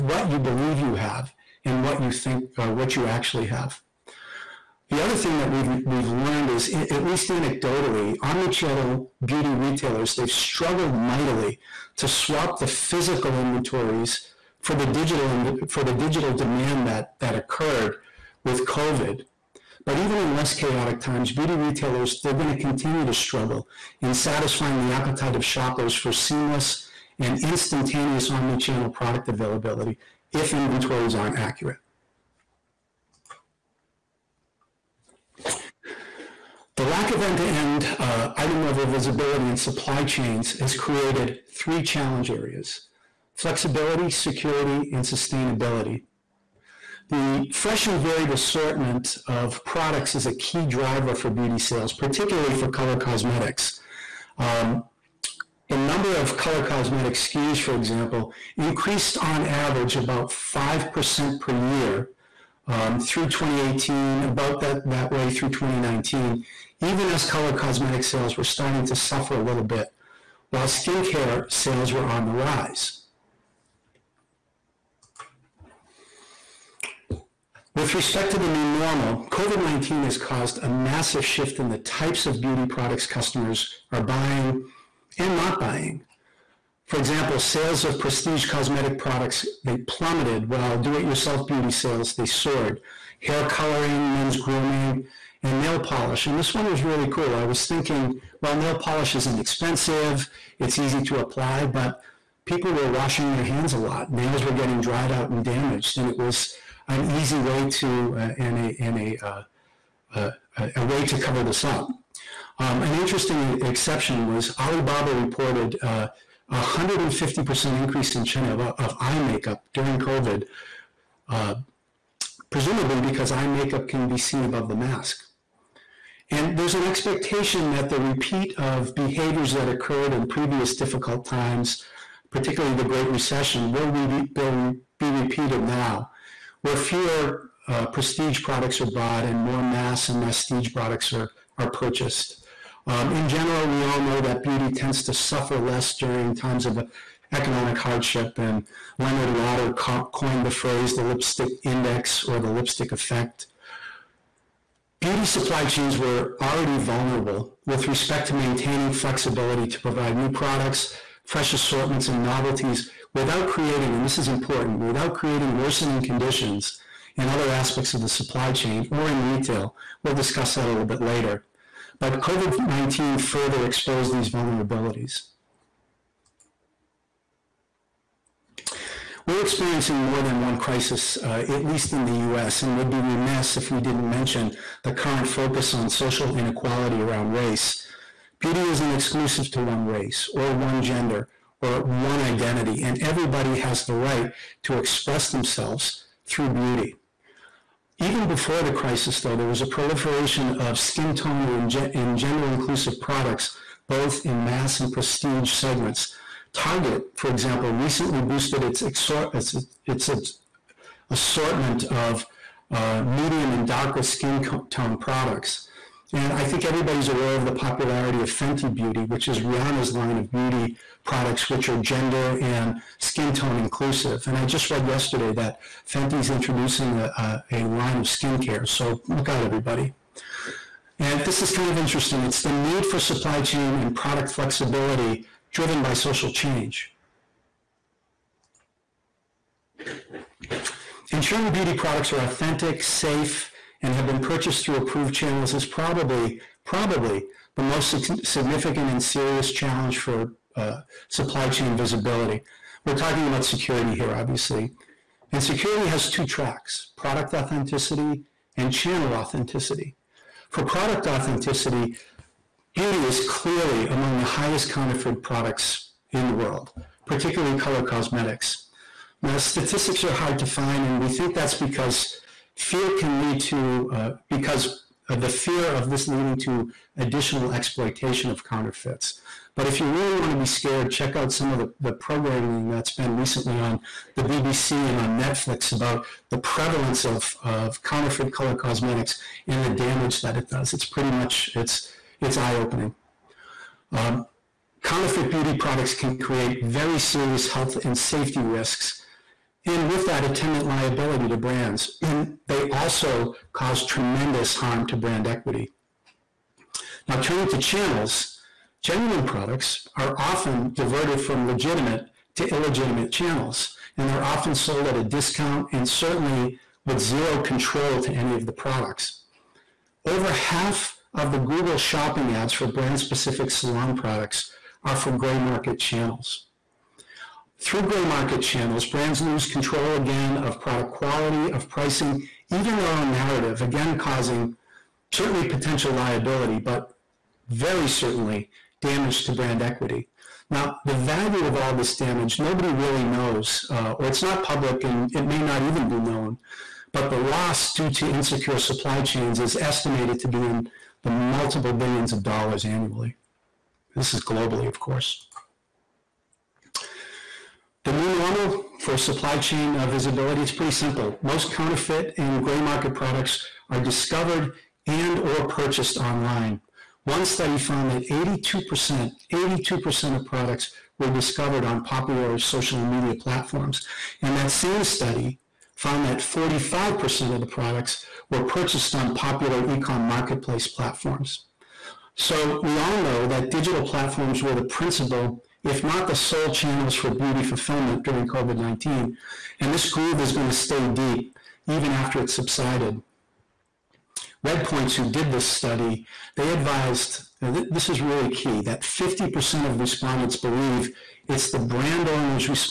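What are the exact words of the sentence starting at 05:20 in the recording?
Over half of the Google shopping ads for brand specific salon products are for gray market channels.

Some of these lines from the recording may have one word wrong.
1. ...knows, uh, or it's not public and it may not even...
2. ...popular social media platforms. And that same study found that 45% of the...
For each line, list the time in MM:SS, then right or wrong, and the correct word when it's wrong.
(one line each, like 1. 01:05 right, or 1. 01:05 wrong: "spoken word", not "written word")
1. 05:43 right
2. 06:11 right.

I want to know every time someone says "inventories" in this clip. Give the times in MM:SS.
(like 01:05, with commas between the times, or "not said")
00:13, 00:30.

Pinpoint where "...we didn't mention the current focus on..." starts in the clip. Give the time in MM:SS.
03:03.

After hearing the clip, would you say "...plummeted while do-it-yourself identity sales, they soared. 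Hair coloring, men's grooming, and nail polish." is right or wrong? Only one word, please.
wrong.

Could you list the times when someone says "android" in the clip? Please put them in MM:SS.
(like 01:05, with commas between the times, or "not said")
not said.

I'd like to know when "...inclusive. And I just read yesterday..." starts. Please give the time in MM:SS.
03:43.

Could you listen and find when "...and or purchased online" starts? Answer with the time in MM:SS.
06:04.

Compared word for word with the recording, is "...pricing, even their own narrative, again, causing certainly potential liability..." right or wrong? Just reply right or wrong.
right.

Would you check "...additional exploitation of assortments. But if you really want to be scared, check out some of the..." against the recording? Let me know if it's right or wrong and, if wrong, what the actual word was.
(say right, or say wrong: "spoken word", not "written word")
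wrong: "counterfeits", not "assortments".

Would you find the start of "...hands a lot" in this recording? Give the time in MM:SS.
01:43.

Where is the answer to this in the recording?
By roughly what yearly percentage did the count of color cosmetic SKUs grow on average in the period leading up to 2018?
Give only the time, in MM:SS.
01:00.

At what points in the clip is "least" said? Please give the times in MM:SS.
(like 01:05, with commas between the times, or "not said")
00:07, 03:01.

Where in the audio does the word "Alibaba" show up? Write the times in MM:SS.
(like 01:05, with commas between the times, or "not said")
01:54.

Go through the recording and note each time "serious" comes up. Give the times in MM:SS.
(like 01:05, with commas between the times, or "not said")
04:09, 04:56.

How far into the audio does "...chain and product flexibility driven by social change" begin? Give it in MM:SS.
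03:53.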